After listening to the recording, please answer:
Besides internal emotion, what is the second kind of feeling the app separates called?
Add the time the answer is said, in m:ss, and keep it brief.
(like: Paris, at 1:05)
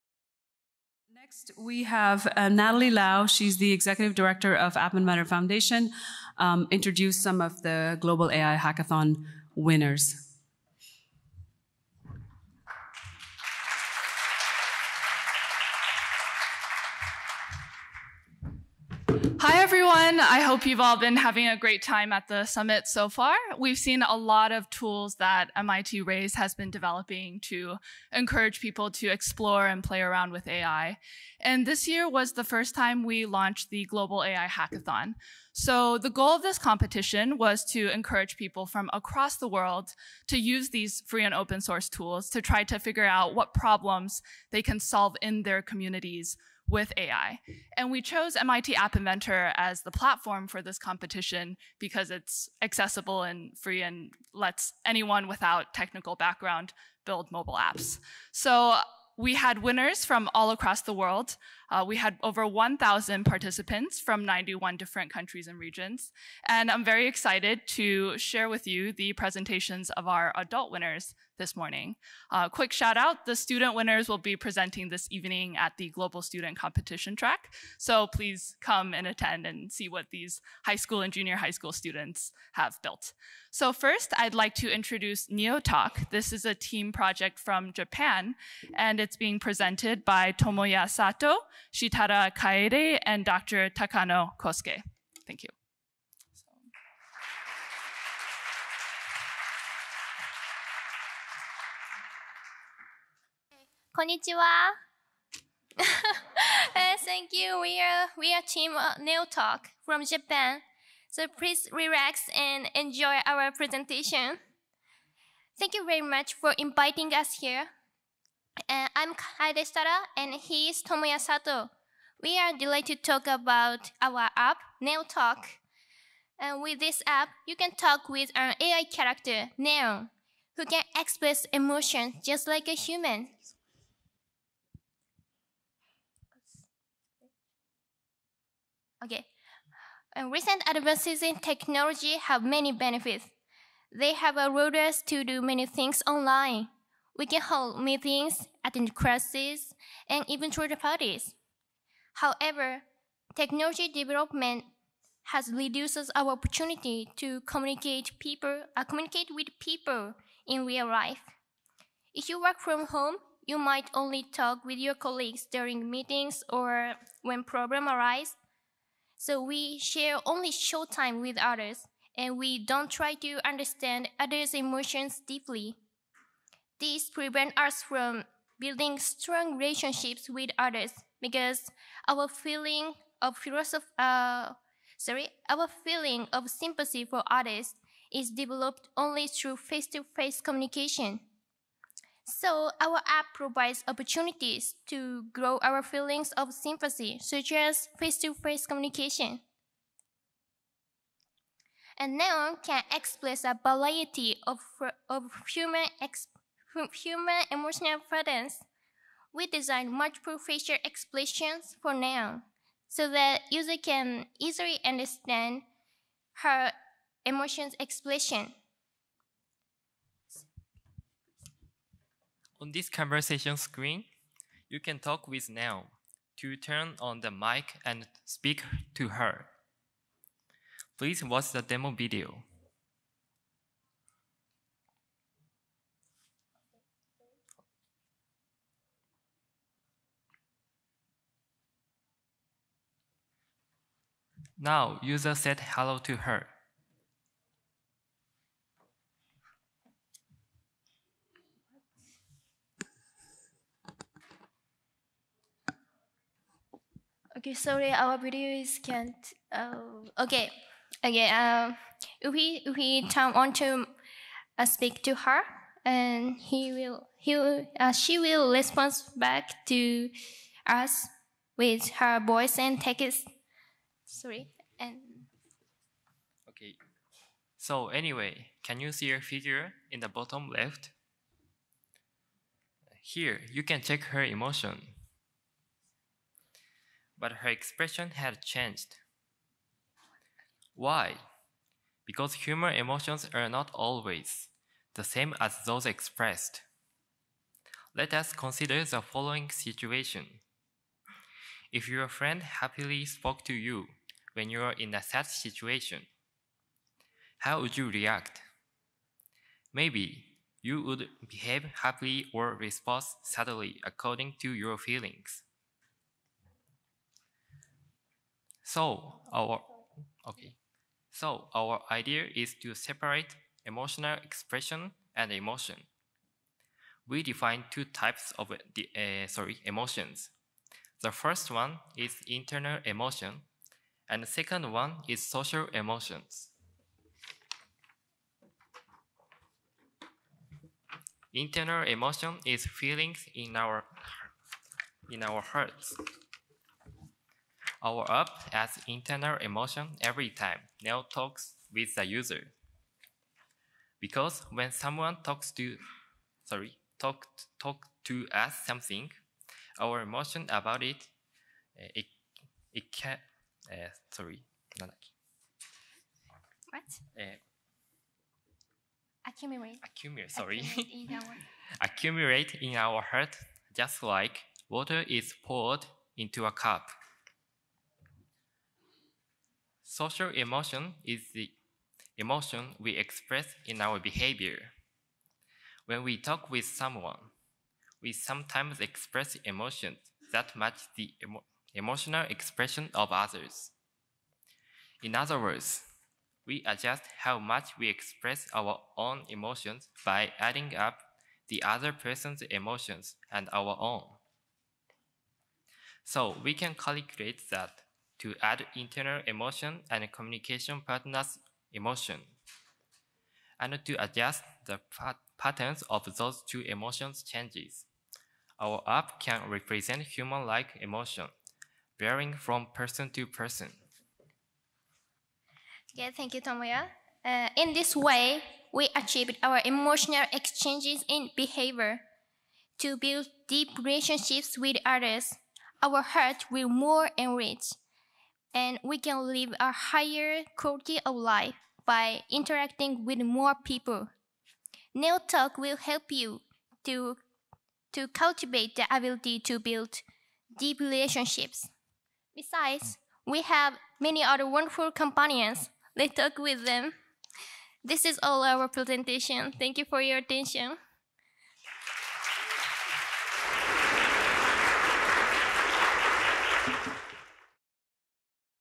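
social emotion, at 5:35.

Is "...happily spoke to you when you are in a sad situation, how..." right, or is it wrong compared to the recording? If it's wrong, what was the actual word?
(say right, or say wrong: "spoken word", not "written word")
right.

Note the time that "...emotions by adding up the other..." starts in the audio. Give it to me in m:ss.
6:39.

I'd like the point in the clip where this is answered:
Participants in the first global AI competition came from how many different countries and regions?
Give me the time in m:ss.
1:04.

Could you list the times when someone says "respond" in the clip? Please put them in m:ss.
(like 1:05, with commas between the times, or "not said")
4:28, 5:12.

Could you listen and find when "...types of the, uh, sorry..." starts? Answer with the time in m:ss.
5:27.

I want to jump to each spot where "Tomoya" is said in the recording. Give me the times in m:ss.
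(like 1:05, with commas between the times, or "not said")
1:30, 2:00, 7:06.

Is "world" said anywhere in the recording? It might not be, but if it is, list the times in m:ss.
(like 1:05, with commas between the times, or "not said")
0:39, 1:00.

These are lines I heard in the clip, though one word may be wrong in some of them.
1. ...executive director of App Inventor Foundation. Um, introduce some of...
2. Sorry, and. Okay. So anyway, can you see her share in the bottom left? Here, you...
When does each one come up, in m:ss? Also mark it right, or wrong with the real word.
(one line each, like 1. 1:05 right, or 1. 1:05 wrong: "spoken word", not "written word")
1. 0:03 right
2. 4:34 wrong: "figure", not "share".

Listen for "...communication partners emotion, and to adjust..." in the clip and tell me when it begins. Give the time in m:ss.
6:50.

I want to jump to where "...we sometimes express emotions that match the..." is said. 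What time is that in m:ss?
6:28.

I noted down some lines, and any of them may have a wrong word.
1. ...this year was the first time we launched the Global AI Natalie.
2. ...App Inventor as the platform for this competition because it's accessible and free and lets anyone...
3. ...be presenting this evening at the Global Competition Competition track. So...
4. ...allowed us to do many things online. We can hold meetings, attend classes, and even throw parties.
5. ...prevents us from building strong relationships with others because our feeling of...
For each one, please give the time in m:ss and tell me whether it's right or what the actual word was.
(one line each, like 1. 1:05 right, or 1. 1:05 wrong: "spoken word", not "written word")
1. 0:31 wrong: "Hackathon", not "Natalie"
2. 0:48 right
3. 1:14 wrong: "Student", not "Competition"
4. 2:24 right
5. 2:57 right.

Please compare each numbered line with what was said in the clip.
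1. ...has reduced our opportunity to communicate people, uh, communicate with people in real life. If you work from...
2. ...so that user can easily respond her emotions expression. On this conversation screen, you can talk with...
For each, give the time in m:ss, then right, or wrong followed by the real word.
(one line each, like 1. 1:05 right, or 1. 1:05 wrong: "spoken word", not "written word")
1. 2:35 right
2. 3:32 wrong: "understand", not "respond".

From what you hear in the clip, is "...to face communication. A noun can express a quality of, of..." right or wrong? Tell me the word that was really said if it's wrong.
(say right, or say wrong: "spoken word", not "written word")
wrong: "variety", not "quality".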